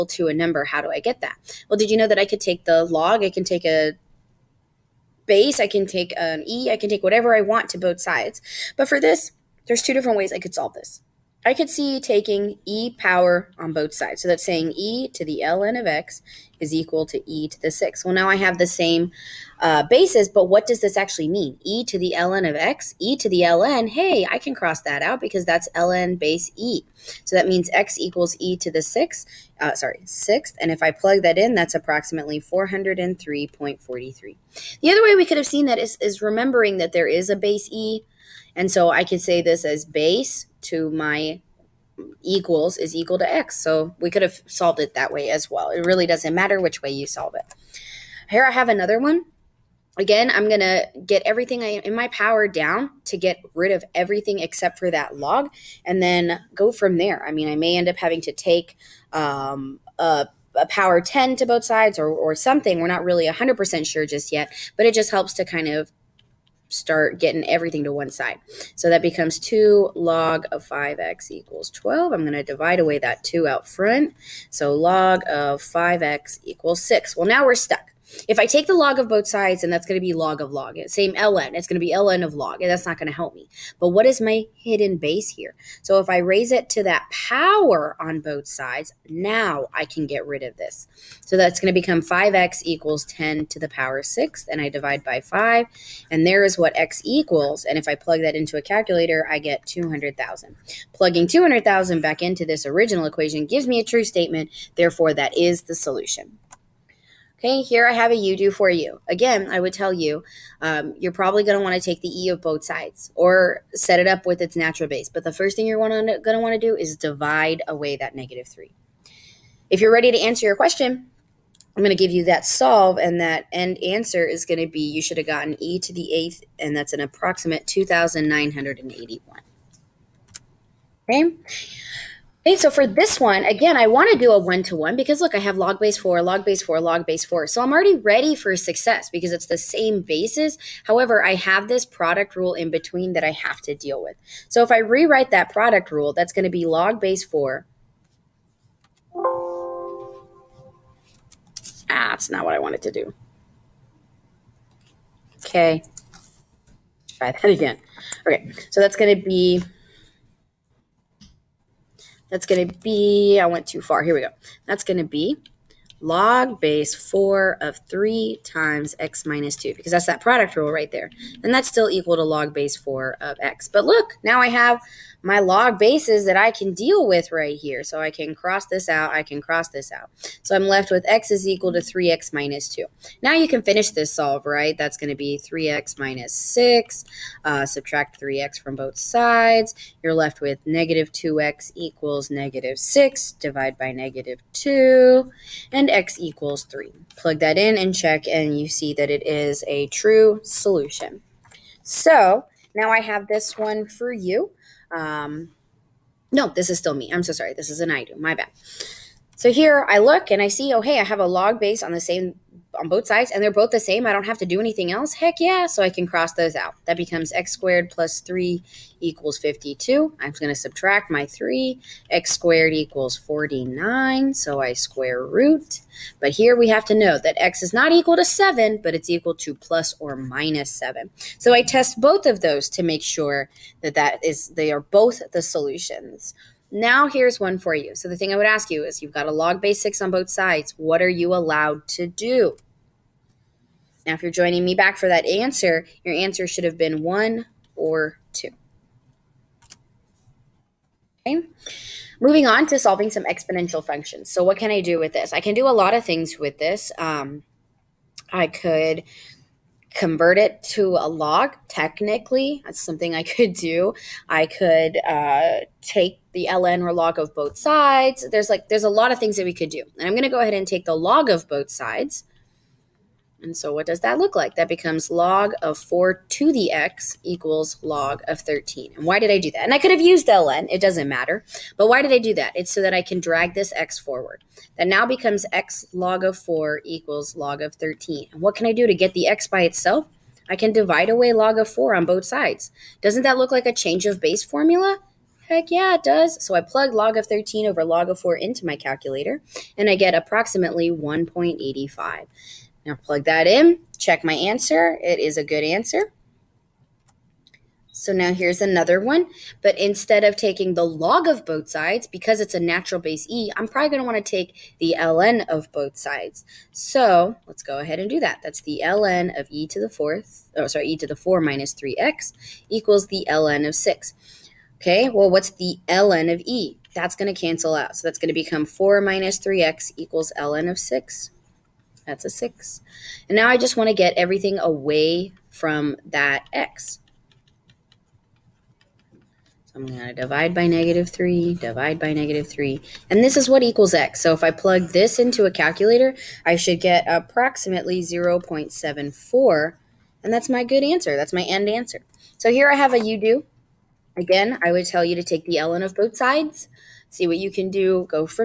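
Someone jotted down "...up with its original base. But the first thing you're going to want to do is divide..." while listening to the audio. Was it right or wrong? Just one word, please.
wrong.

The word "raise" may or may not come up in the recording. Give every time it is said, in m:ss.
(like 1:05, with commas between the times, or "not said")
1:26.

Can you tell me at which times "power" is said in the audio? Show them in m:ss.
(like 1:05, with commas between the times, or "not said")
0:12, 0:52, 1:00, 1:27, 1:33.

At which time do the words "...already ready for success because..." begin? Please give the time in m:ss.
2:17.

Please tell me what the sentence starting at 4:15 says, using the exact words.
I can do a lot of things with this.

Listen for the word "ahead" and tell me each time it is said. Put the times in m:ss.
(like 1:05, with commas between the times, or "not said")
4:30, 5:17.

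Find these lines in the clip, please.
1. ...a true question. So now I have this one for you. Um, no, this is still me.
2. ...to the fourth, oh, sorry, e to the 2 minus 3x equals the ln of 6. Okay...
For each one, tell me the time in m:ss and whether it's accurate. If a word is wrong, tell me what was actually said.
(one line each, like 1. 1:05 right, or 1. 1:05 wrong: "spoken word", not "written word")
1. 3:19 wrong: "solution", not "question"
2. 5:19 wrong: "4", not "2".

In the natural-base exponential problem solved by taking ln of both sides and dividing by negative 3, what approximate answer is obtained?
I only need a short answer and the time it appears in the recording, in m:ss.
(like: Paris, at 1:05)
0.74, at 5:48.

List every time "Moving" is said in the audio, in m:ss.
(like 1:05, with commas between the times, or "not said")
4:12.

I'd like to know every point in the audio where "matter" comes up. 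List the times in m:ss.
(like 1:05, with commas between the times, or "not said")
0:46, 4:41.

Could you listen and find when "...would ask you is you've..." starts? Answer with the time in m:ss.
3:58.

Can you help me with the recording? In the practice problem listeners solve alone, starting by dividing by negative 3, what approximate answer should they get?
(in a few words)
2,981.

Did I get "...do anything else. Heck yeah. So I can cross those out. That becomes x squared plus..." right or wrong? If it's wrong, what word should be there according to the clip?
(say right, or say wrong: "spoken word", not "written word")
right.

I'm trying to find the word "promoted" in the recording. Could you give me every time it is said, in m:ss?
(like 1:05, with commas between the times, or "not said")
not said.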